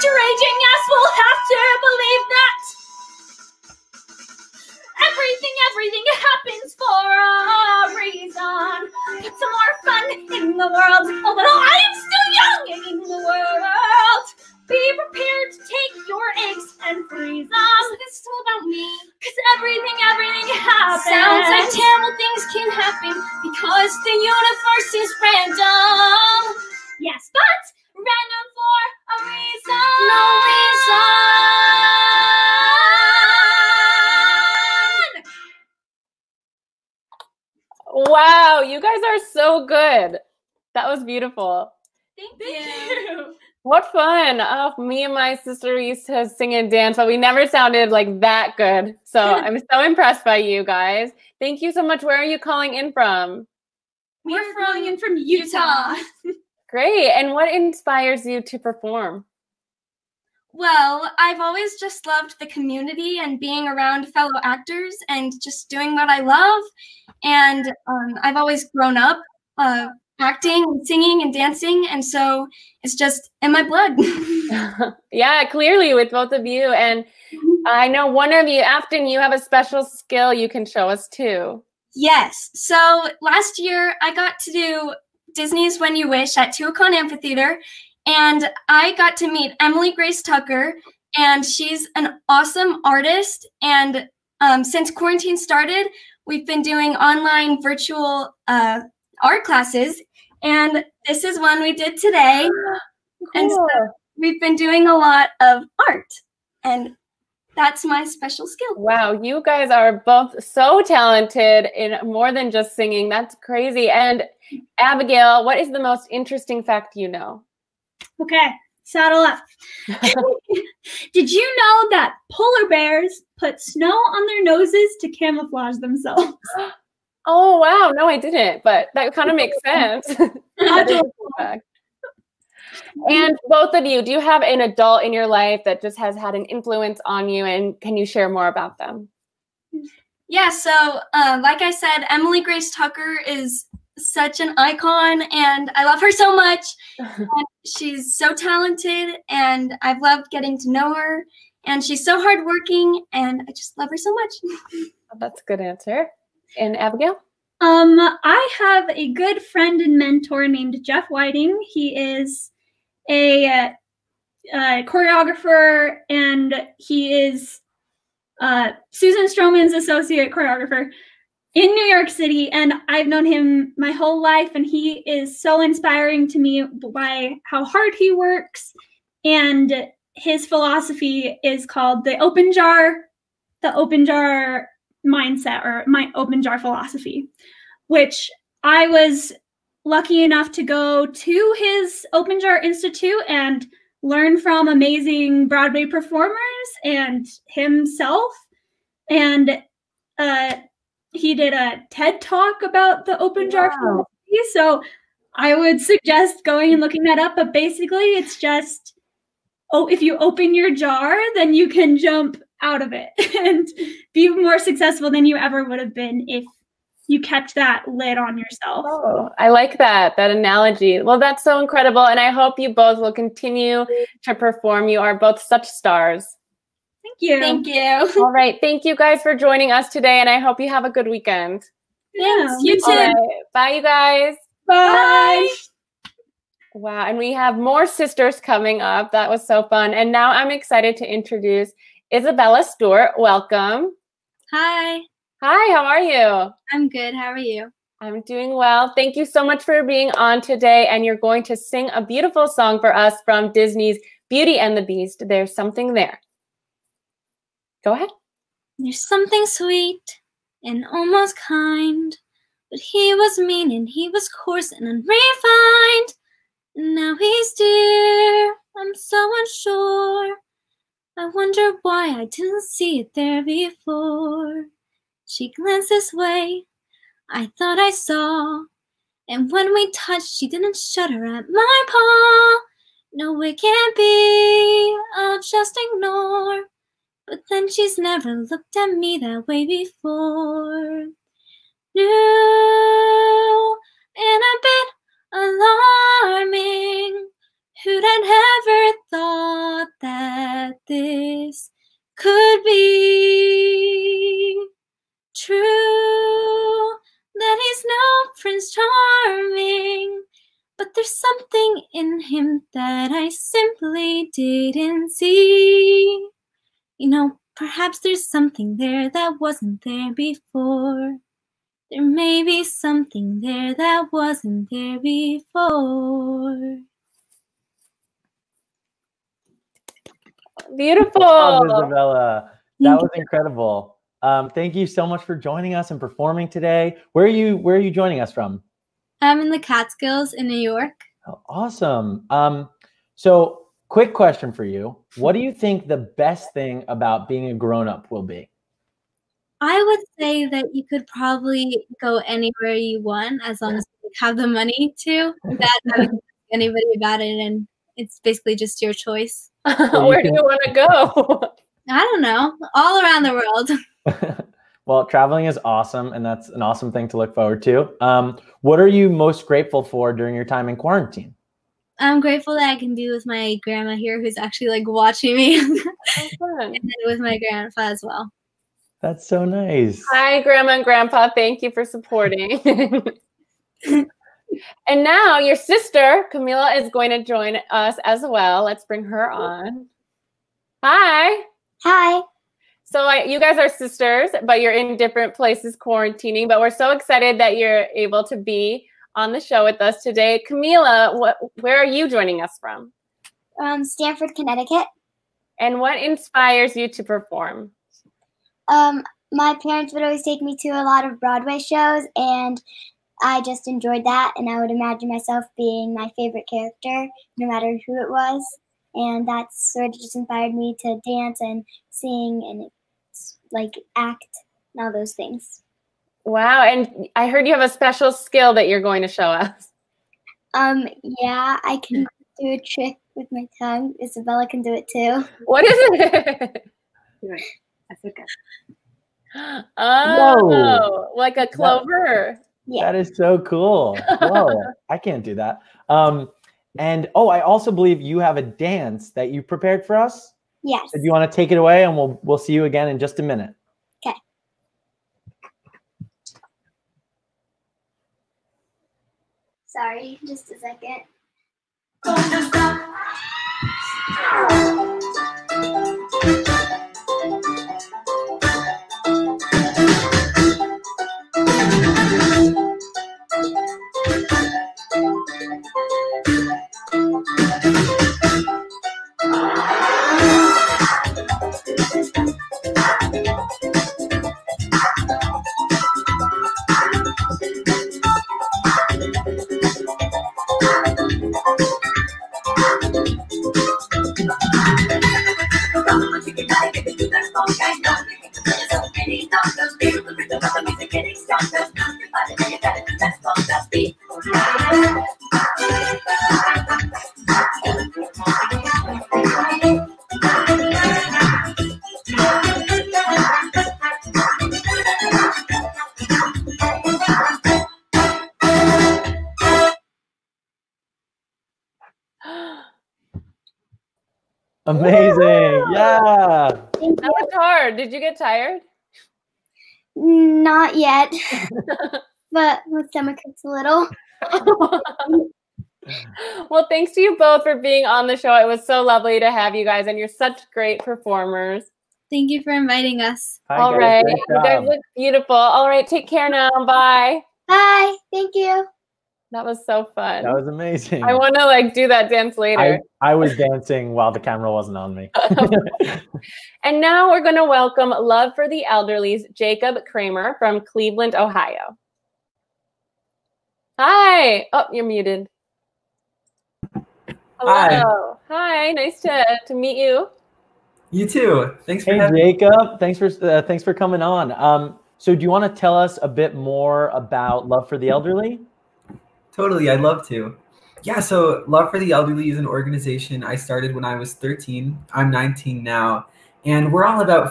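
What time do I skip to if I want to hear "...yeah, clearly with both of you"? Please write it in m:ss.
1:15.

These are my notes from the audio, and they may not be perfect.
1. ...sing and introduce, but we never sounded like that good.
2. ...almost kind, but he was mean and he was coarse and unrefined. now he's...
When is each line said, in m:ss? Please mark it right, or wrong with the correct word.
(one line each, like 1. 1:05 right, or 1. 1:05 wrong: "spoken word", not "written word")
1. 0:46 wrong: "dance", not "introduce"
2. 4:20 right.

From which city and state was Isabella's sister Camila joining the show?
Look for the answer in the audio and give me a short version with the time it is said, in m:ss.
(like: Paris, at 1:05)
Stamford, Connecticut, at 6:43.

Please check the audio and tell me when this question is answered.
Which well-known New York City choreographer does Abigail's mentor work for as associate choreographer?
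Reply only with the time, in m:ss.
2:48.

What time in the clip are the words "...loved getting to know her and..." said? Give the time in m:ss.
2:30.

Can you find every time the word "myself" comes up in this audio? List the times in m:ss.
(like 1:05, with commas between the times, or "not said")
6:55.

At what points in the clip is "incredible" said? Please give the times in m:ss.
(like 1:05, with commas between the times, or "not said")
3:41, 5:33.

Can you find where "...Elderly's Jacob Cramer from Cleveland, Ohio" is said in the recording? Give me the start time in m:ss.
9:18.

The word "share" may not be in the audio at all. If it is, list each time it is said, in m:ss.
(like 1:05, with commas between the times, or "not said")
2:18.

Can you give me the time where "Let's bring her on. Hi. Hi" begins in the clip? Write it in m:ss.
6:28.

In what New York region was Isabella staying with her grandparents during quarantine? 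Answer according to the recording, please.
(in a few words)
The Catskills.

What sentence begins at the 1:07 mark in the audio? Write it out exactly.
And um, I've always grown up uh, acting and singing and dancing.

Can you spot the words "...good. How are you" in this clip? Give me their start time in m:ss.
4:06.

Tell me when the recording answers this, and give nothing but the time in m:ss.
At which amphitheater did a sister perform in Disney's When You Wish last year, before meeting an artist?
1:26.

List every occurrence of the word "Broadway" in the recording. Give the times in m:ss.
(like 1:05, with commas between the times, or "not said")
3:15, 6:51.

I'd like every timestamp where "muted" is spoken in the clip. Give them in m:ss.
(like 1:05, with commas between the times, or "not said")
9:24.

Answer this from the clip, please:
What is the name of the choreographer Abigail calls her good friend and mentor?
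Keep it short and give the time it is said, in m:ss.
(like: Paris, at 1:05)
Jeff Whiting, at 2:40.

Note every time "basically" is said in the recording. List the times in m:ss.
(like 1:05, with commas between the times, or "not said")
3:27, 5:58.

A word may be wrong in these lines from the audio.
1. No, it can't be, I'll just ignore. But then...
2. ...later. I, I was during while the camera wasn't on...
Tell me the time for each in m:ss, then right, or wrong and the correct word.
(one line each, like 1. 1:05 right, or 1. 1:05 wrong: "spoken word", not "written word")
1. 4:43 right
2. 9:12 wrong: "dancing", not "during".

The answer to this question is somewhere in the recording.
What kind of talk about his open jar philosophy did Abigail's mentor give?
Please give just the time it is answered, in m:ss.
3:21.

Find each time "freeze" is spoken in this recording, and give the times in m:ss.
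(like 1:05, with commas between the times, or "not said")
0:17.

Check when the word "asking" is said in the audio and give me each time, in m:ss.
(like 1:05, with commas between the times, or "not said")
not said.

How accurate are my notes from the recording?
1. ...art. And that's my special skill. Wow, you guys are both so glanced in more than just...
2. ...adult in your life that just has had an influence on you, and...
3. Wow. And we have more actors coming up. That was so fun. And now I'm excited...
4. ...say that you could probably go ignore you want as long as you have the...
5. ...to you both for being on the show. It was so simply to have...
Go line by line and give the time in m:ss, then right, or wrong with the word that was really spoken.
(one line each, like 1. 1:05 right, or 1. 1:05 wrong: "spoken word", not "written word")
1. 1:45 wrong: "talented", not "glanced"
2. 2:14 right
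3. 3:56 wrong: "sisters", not "actors"
4. 5:50 wrong: "anywhere", not "ignore"
5. 8:56 wrong: "lovely", not "simply".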